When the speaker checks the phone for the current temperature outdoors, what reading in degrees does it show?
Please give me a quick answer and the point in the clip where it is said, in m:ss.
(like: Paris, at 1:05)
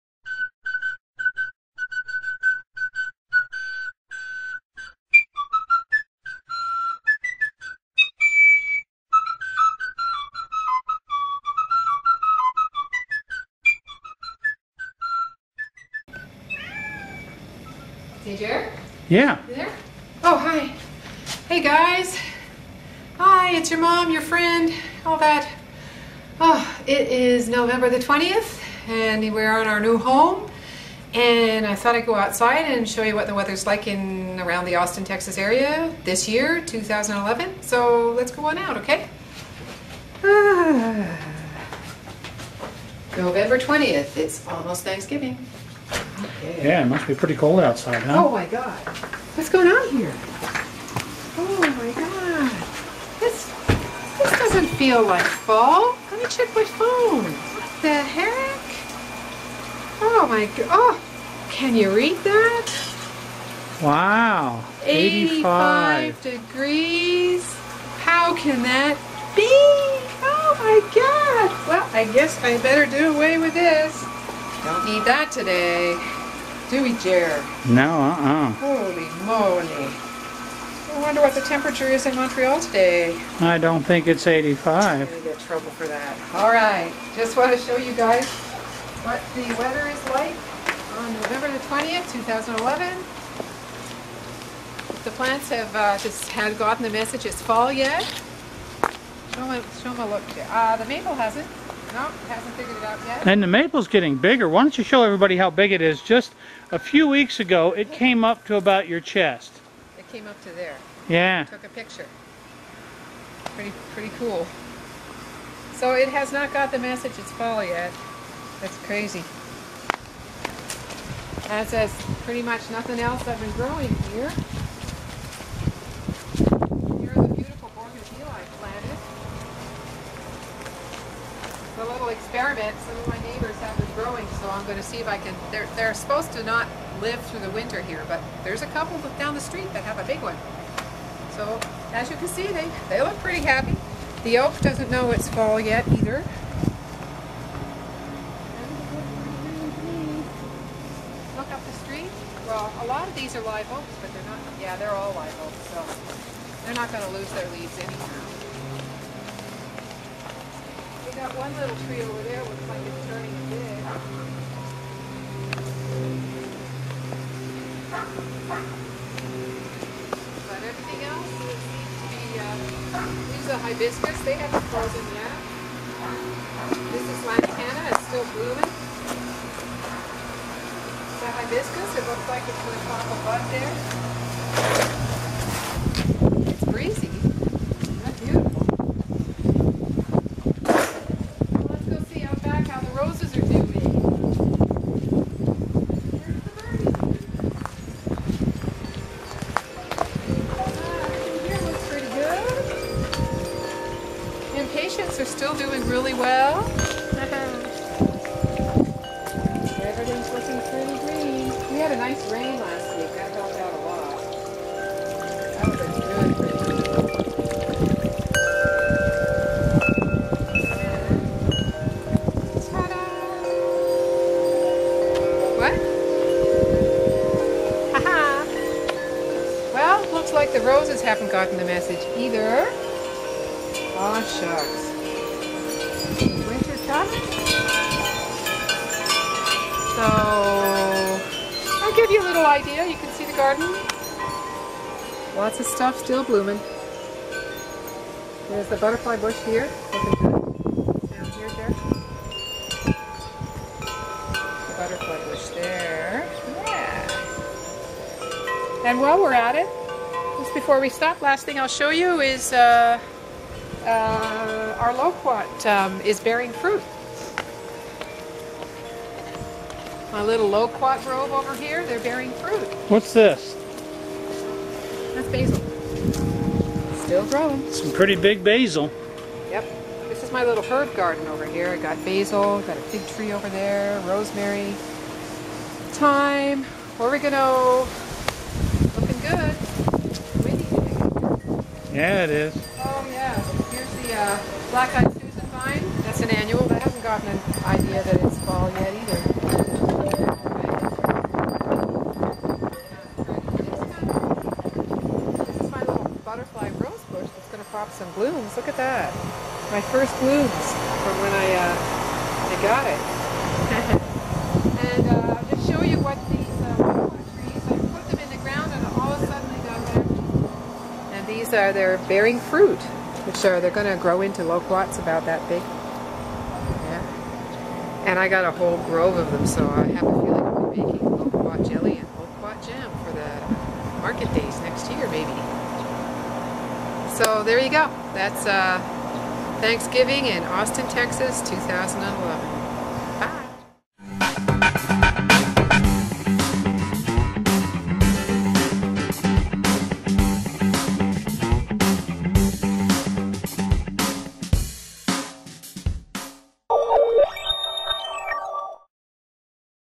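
85, at 1:06.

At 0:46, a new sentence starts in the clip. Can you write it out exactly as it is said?
Yeah, it must be pretty cold outside, huh?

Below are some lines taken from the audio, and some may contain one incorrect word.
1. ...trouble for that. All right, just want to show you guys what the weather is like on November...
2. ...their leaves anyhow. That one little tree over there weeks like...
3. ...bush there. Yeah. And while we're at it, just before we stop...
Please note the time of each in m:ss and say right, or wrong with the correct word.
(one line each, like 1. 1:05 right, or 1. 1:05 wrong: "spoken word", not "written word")
1. 1:25 right
2. 2:37 wrong: "looks", not "weeks"
3. 4:15 right.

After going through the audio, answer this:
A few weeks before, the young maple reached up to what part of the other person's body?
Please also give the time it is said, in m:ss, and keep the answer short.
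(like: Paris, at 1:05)
Chest, at 1:48.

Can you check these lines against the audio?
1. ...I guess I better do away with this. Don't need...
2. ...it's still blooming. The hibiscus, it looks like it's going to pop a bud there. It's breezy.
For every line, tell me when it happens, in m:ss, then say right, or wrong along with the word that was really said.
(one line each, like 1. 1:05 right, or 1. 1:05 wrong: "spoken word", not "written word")
1. 1:11 right
2. 2:57 right.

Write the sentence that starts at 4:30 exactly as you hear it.
My little loquat grove over here, they're bearing fruit.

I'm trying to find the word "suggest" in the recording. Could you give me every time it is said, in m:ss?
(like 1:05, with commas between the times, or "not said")
not said.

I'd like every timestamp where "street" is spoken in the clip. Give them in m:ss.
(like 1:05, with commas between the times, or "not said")
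2:19, 2:31.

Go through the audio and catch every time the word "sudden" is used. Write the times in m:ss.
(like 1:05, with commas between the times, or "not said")
5:19.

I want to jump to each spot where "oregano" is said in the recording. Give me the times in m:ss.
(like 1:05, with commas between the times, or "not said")
4:46.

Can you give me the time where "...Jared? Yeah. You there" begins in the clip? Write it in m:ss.
0:18.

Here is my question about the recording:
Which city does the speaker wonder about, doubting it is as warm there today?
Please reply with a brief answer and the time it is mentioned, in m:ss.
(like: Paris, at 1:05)
Montreal, at 1:22.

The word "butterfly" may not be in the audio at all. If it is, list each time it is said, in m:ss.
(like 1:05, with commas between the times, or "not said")
4:08, 4:14, 5:06.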